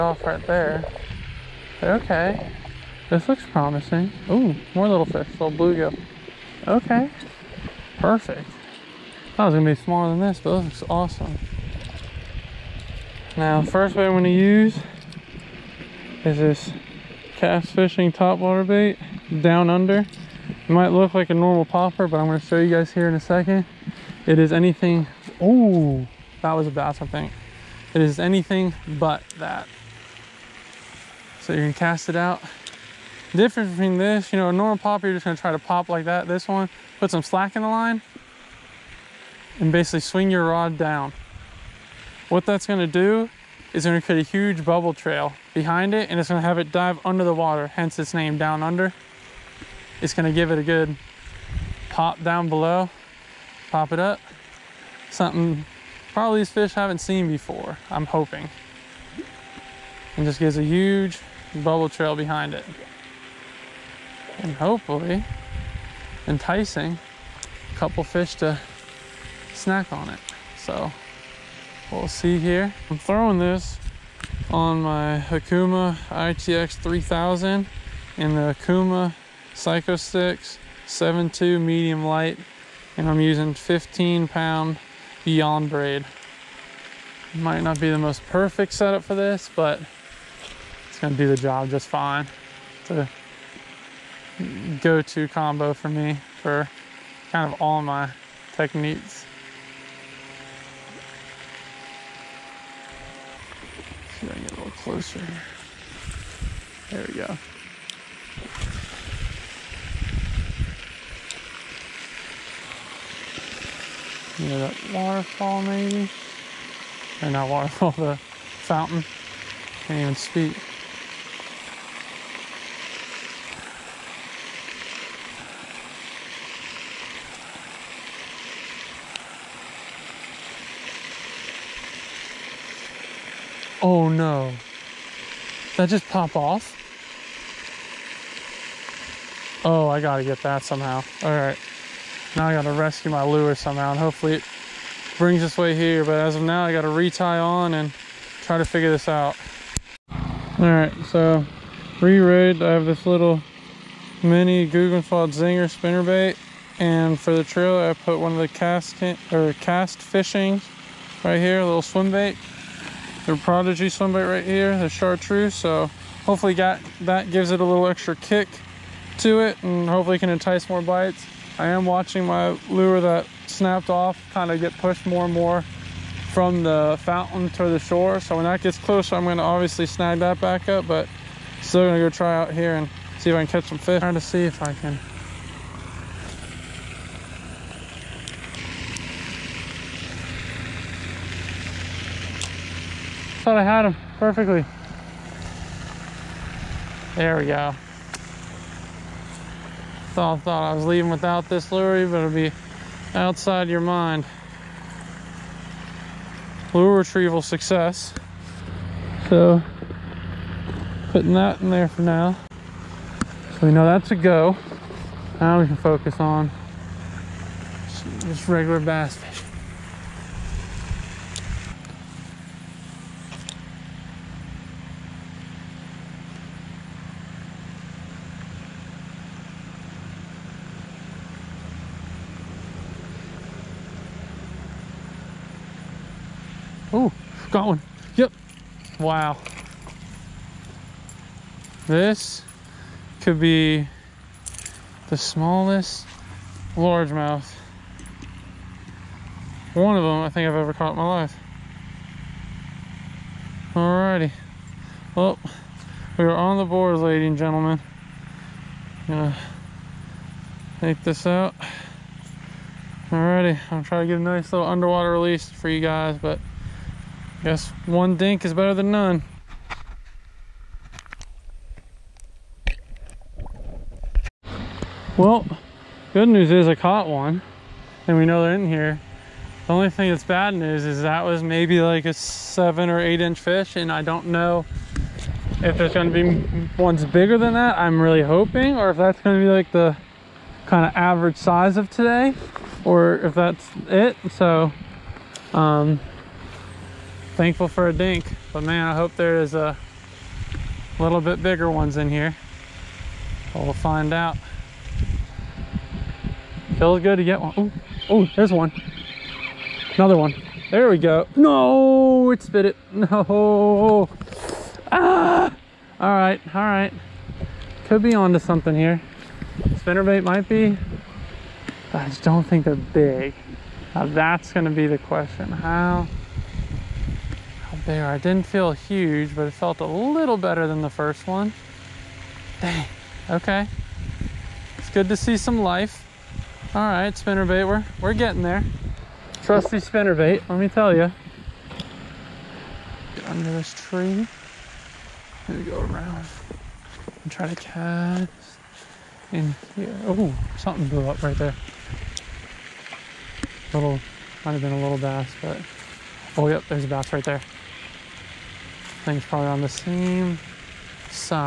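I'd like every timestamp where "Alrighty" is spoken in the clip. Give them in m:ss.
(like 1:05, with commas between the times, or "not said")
4:13, 4:23.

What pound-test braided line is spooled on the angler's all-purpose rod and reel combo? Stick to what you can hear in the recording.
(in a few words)
15 pound.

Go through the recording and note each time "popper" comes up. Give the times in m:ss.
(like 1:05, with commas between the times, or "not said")
0:21, 0:34.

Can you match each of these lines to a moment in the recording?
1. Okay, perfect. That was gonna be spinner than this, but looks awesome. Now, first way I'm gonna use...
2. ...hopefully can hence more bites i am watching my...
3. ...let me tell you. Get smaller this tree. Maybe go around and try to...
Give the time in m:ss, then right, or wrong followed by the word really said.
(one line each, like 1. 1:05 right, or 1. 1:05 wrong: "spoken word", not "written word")
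1. 0:06 wrong: "smaller", not "spinner"
2. 2:49 wrong: "entice", not "hence"
3. 5:40 wrong: "under", not "smaller".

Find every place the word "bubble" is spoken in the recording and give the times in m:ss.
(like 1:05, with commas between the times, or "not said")
0:44, 1:01.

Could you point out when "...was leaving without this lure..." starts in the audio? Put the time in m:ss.
3:20.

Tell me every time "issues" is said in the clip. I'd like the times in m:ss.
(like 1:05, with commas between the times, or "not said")
not said.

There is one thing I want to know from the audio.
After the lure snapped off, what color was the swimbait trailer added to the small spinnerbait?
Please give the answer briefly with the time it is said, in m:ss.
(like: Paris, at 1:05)
chartreuse, at 2:44.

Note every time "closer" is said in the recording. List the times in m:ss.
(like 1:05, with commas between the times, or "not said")
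1:44, 2:58.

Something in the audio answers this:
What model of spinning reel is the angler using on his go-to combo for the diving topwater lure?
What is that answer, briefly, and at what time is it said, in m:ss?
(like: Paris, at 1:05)
Okuma ITX 3000, at 1:15.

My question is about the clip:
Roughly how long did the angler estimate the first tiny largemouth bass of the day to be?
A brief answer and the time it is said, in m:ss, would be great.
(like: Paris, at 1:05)
7 or 8 inches, at 4:42.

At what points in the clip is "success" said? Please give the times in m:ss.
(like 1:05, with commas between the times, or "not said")
3:27.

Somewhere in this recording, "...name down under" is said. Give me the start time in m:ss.
0:48.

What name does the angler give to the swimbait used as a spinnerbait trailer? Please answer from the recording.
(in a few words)
Prodigy.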